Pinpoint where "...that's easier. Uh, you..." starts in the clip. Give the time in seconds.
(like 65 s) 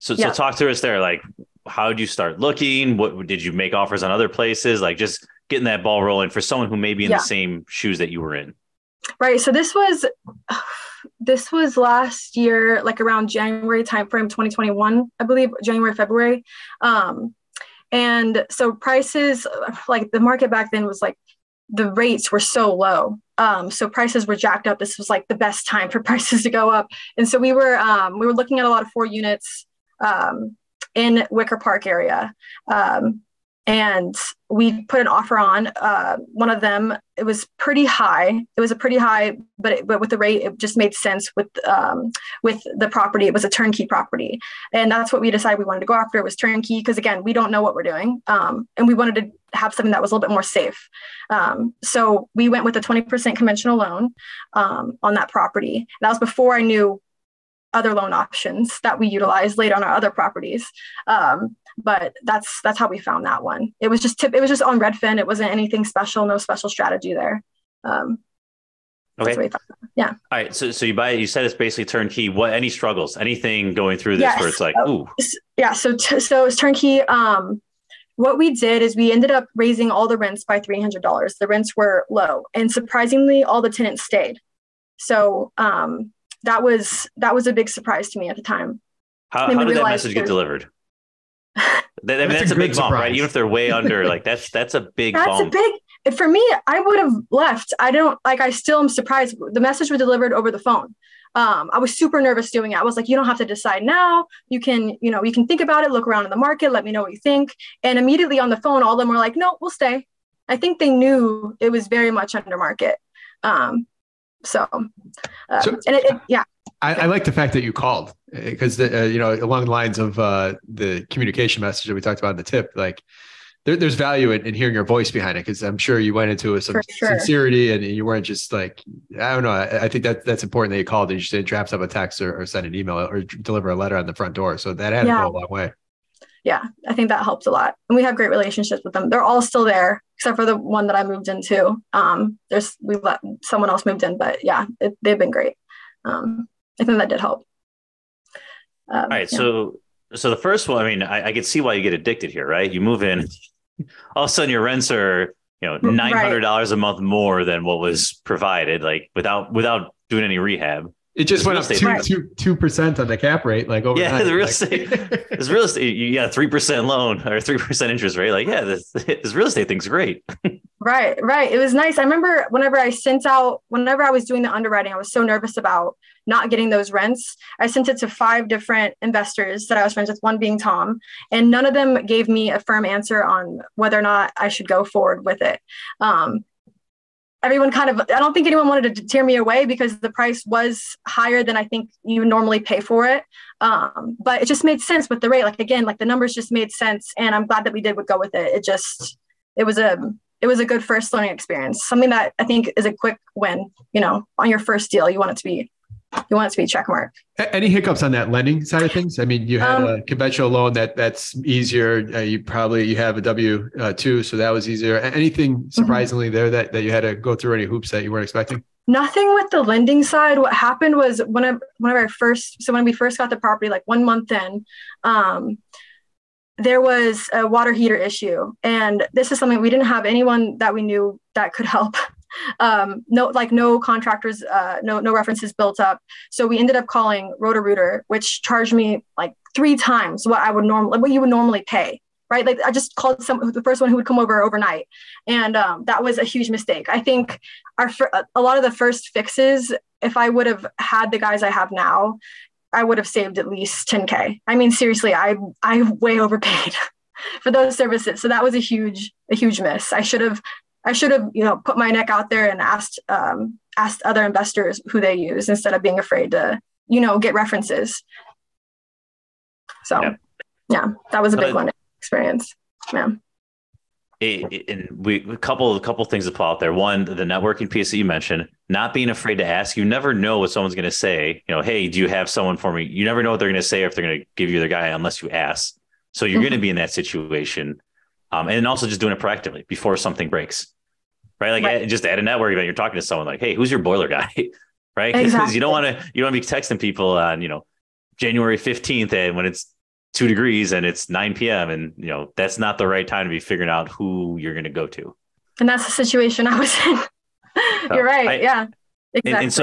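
210 s.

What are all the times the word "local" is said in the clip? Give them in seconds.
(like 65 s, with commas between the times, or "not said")
not said.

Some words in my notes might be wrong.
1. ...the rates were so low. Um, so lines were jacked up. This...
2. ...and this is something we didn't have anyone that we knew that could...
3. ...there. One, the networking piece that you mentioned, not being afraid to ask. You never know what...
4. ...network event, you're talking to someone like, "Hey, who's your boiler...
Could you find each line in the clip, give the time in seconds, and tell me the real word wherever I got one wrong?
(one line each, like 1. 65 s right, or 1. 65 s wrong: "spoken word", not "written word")
1. 21 s wrong: "prices", not "lines"
2. 228 s right
3. 276 s right
4. 292 s right.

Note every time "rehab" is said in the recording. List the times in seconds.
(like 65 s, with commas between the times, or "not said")
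160 s.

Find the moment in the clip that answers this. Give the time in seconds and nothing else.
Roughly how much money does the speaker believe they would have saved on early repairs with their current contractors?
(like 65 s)
253 s.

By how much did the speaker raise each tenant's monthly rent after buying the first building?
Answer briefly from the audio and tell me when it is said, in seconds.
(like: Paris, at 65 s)
$300, at 80 s.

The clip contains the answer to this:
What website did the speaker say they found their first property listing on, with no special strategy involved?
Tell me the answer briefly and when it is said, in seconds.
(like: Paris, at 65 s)
Redfin, at 64 s.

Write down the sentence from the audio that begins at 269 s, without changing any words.
So, yeah, yeah that was a big one experience.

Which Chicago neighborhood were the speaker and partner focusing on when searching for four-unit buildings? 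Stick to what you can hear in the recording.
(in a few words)
Wicker Park.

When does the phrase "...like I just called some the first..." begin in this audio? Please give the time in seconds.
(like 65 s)
242 s.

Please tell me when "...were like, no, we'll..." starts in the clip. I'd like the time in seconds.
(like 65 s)
109 s.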